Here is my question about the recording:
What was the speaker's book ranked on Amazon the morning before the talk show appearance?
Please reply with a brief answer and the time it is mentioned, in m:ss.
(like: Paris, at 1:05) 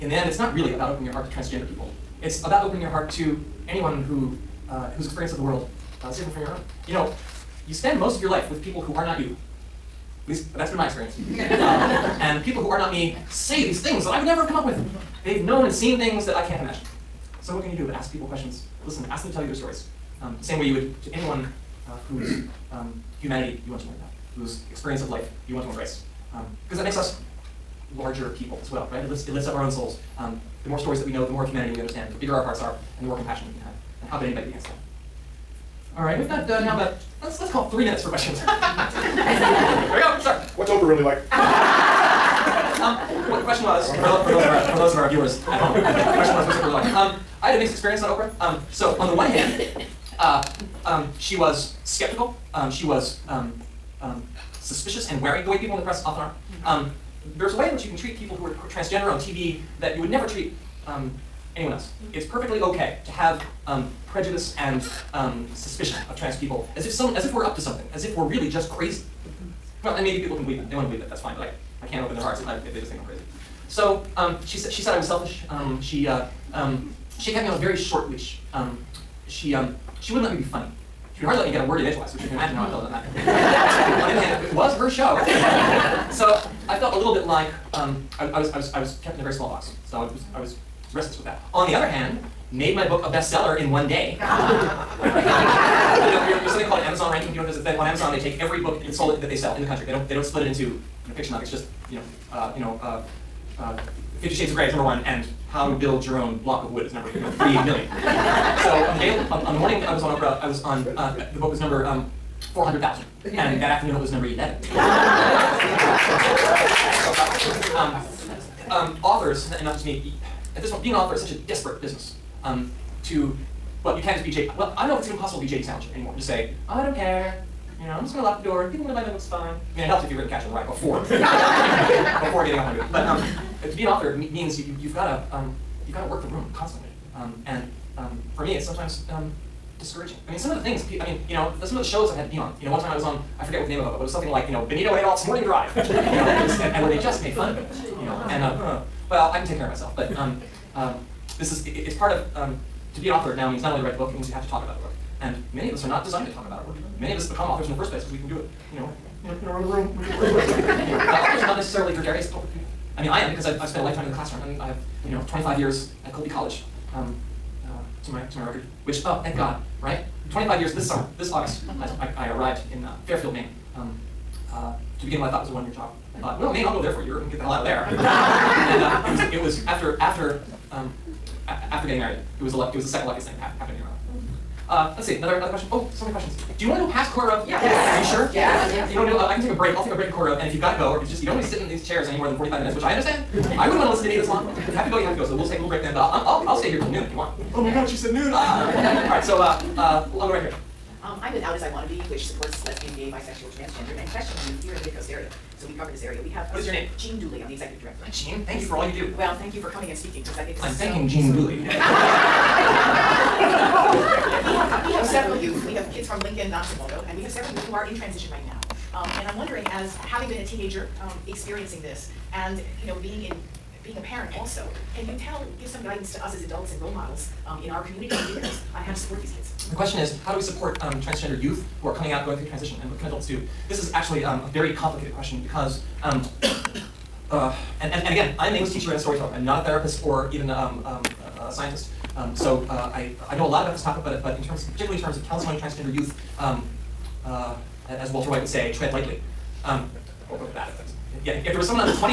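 400,000, at 1:52.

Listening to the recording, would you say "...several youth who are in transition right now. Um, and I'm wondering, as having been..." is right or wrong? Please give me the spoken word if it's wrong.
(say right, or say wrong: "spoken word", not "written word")
right.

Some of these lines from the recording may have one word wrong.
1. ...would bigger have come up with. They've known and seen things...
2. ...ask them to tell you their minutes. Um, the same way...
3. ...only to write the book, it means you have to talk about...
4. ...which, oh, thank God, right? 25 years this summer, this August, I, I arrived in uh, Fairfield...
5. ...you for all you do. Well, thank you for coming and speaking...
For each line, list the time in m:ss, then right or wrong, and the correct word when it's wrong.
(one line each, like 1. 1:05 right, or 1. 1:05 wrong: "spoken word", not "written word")
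1. 0:14 wrong: "never", not "bigger"
2. 0:19 wrong: "stories", not "minutes"
3. 2:33 right
4. 2:48 right
5. 3:28 right.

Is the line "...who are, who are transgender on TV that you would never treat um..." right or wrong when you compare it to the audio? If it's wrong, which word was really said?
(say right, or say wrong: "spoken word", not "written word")
right.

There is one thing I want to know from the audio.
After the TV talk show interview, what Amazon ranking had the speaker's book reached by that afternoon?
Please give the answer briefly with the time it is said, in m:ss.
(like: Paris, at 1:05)
11, at 1:54.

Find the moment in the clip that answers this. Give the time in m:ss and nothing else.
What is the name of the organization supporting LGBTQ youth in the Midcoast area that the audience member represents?
3:21.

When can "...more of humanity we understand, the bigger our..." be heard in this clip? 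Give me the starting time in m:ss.
0:31.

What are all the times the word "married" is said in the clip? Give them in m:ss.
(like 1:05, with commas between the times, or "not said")
3:01.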